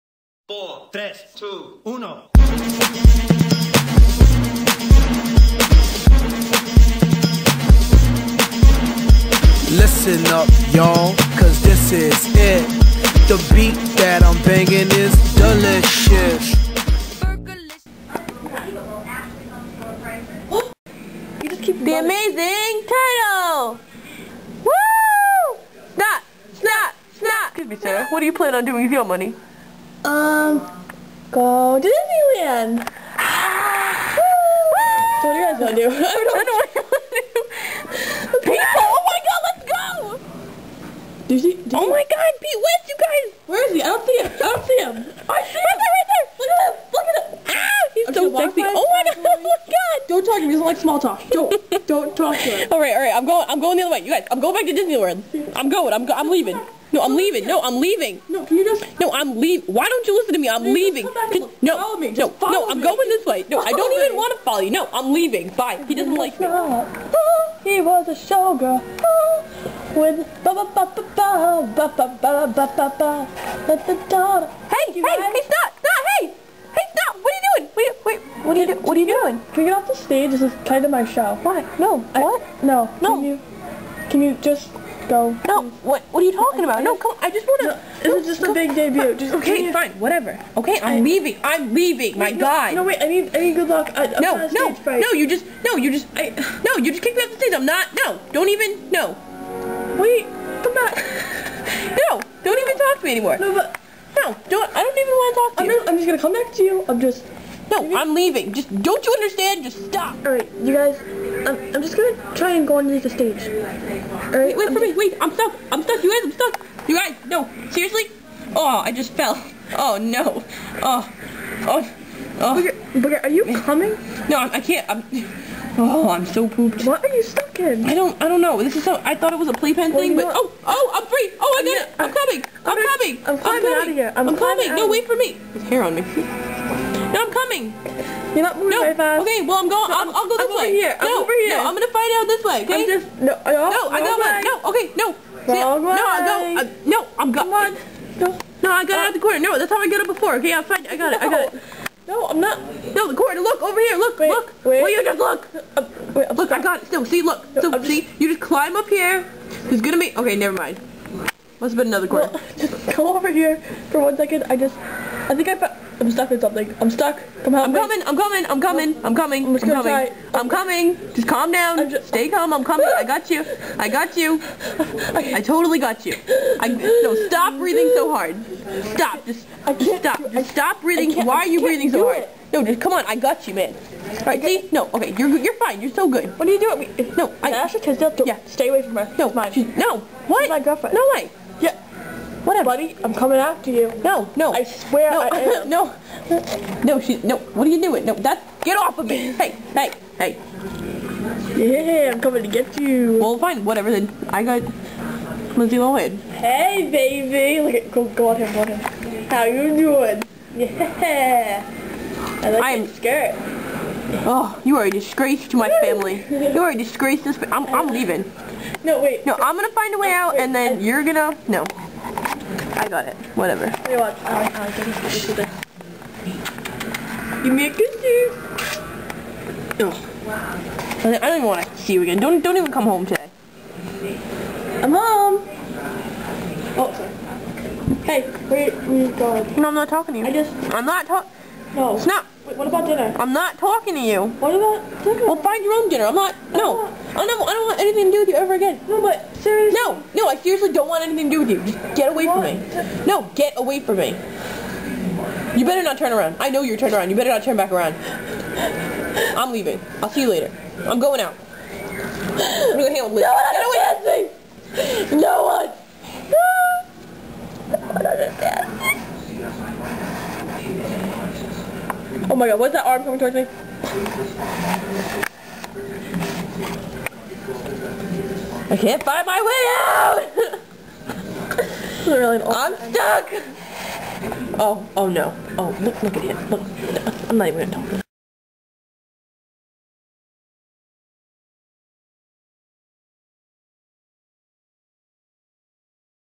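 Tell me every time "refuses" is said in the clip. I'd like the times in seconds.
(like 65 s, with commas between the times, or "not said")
not said.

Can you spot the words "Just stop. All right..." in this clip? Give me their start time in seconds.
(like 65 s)
109 s.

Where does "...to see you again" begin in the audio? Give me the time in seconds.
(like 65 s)
231 s.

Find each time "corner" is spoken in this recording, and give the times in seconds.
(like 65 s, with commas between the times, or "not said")
149 s, 153 s, 162 s.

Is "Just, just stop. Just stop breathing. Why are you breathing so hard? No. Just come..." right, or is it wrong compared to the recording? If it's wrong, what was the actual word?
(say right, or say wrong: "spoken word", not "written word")
right.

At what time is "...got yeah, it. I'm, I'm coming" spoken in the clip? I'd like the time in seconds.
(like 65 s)
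131 s.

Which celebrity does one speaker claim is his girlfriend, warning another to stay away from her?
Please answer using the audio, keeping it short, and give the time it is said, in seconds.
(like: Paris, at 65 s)
Ashley Tisdale, at 187 s.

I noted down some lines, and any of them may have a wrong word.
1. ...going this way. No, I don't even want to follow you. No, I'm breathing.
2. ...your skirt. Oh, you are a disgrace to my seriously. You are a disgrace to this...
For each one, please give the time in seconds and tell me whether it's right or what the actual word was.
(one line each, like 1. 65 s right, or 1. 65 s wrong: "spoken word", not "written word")
1. 62 s wrong: "leaving", not "breathing"
2. 212 s wrong: "family", not "seriously".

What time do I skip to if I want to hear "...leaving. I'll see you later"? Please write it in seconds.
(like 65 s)
259 s.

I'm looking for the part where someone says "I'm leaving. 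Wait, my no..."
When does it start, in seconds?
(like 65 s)
91 s.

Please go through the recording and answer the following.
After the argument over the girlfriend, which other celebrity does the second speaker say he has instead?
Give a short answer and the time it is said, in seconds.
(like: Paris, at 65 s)
Lindsay Lohan, at 205 s.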